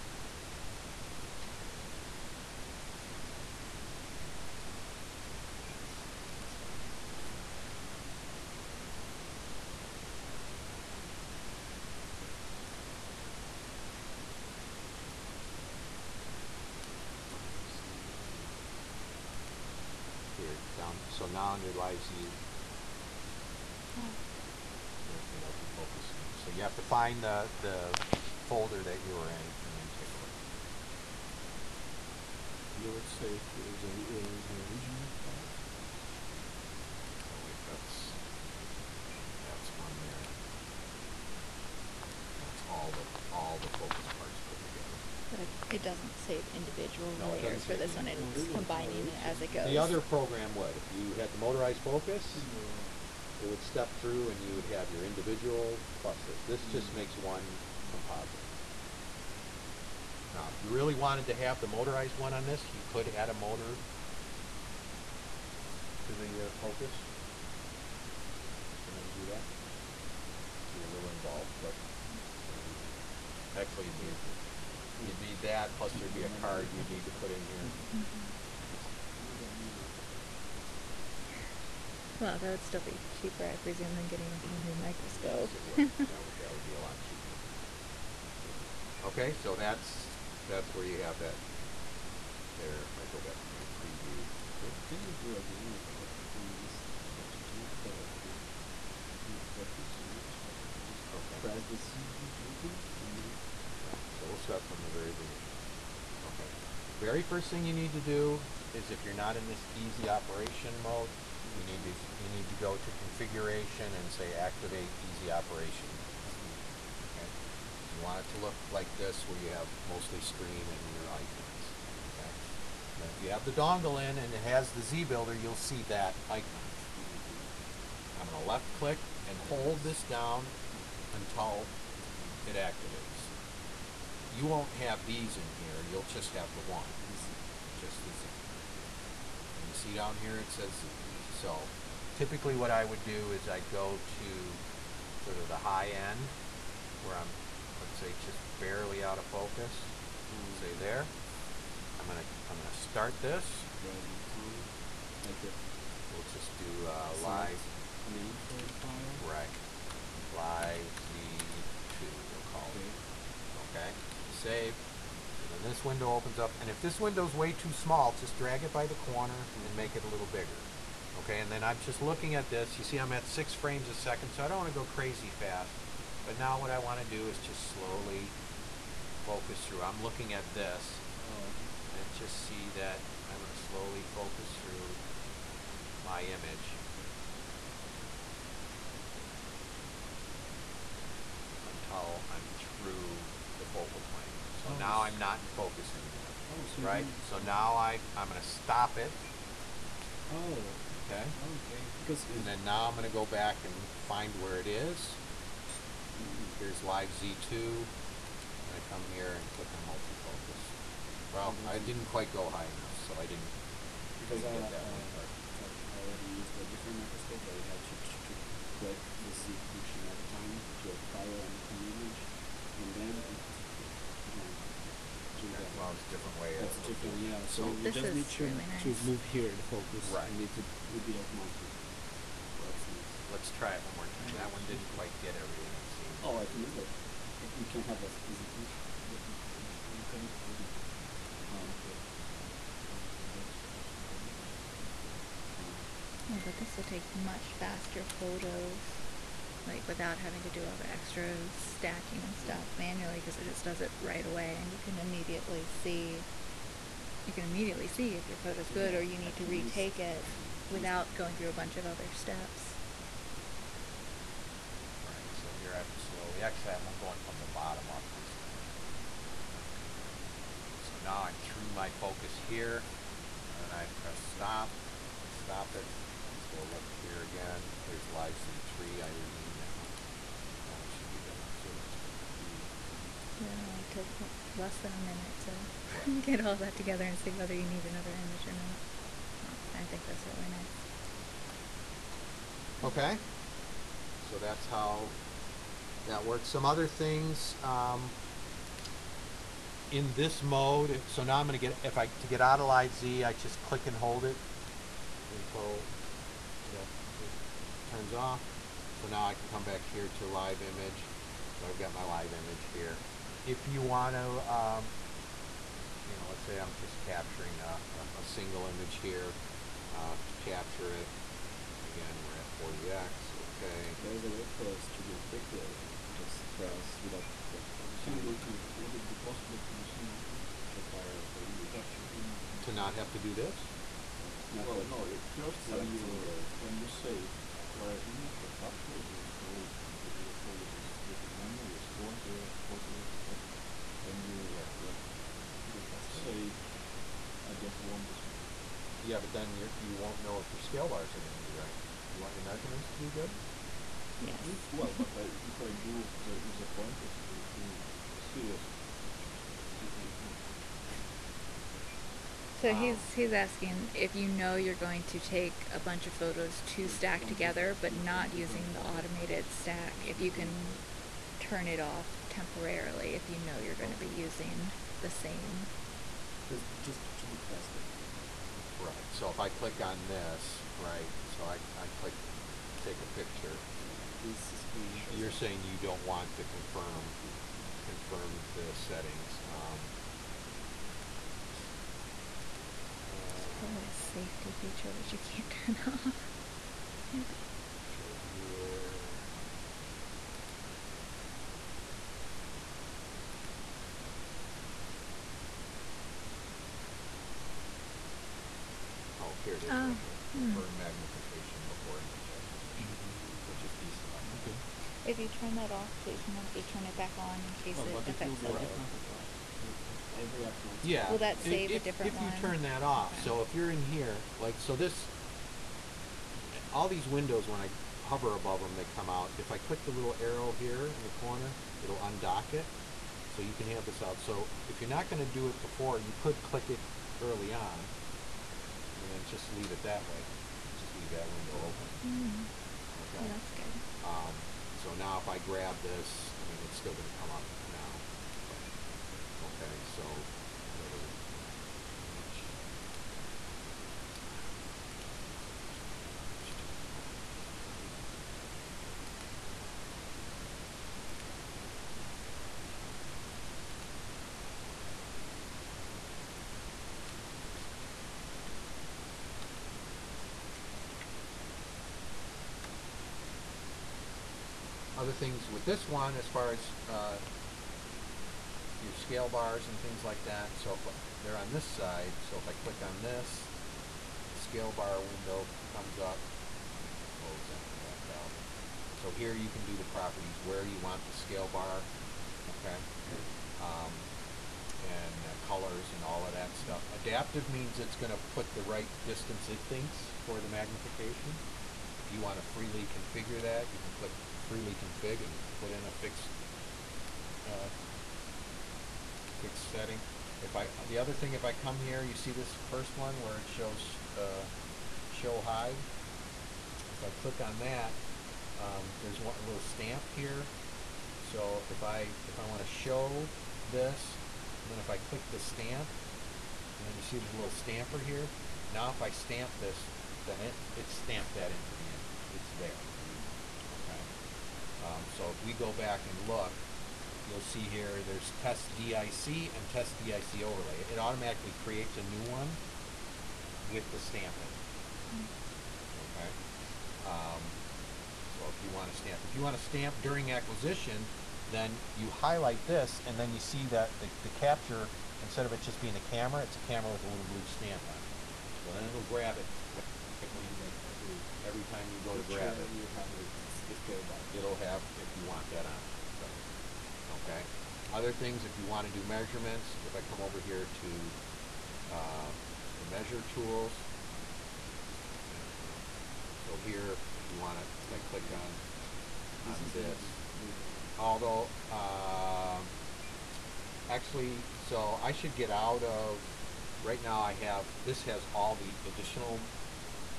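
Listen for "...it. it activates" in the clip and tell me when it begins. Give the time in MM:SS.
02:12.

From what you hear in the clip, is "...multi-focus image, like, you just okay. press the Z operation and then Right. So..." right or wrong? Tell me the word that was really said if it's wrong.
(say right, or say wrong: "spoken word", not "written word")
wrong: "button", not "operation".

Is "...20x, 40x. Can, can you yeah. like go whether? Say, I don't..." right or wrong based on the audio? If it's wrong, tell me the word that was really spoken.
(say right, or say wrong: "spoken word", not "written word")
wrong: "faster", not "whether".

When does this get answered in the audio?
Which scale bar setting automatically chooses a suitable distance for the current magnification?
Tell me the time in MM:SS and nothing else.
08:16.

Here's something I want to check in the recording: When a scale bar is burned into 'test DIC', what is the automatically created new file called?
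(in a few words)
test DIC overlay.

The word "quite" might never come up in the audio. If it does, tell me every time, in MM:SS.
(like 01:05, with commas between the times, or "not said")
03:32, 03:54.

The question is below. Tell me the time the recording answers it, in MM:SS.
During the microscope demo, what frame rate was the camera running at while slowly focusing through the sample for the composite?
02:53.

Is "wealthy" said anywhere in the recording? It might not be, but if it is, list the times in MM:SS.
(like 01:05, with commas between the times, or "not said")
not said.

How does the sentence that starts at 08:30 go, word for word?
If I, the other thing, if I come here, you see this first one where it shows uh, show hide.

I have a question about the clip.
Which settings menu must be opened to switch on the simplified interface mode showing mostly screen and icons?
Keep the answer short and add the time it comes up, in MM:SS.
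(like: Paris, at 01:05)
configuration, at 01:52.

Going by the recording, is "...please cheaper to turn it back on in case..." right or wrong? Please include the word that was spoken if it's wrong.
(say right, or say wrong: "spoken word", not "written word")
wrong: "remember", not "cheaper".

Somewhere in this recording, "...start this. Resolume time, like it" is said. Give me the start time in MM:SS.
02:32.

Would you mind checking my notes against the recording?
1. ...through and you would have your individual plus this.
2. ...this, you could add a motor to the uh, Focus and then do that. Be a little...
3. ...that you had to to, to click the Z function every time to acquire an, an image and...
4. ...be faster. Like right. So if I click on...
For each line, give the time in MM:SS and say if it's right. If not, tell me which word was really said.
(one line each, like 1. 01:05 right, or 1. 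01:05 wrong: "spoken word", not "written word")
1. 00:53 right
2. 01:02 right
3. 03:37 right
4. 06:17 right.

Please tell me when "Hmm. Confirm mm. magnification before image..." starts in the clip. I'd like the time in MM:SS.
06:50.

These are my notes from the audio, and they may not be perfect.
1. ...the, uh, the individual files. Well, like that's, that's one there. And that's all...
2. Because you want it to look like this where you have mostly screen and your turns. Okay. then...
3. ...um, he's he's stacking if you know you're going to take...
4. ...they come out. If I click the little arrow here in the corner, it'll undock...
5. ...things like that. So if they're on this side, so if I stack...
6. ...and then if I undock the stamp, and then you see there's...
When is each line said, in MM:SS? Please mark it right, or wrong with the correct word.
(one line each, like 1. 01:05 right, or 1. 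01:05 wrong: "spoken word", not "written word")
1. 00:33 wrong: "original", not "individual"
2. 01:57 wrong: "icons", not "turns"
3. 06:02 wrong: "asking", not "stacking"
4. 07:08 right
5. 07:59 wrong: "click", not "stack"
6. 08:44 wrong: "click", not "undock".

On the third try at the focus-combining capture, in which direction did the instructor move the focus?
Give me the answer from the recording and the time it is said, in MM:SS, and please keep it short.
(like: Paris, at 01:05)
from the bottom up, at 04:27.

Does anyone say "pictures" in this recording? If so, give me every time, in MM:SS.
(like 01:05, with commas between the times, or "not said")
05:59, 06:23.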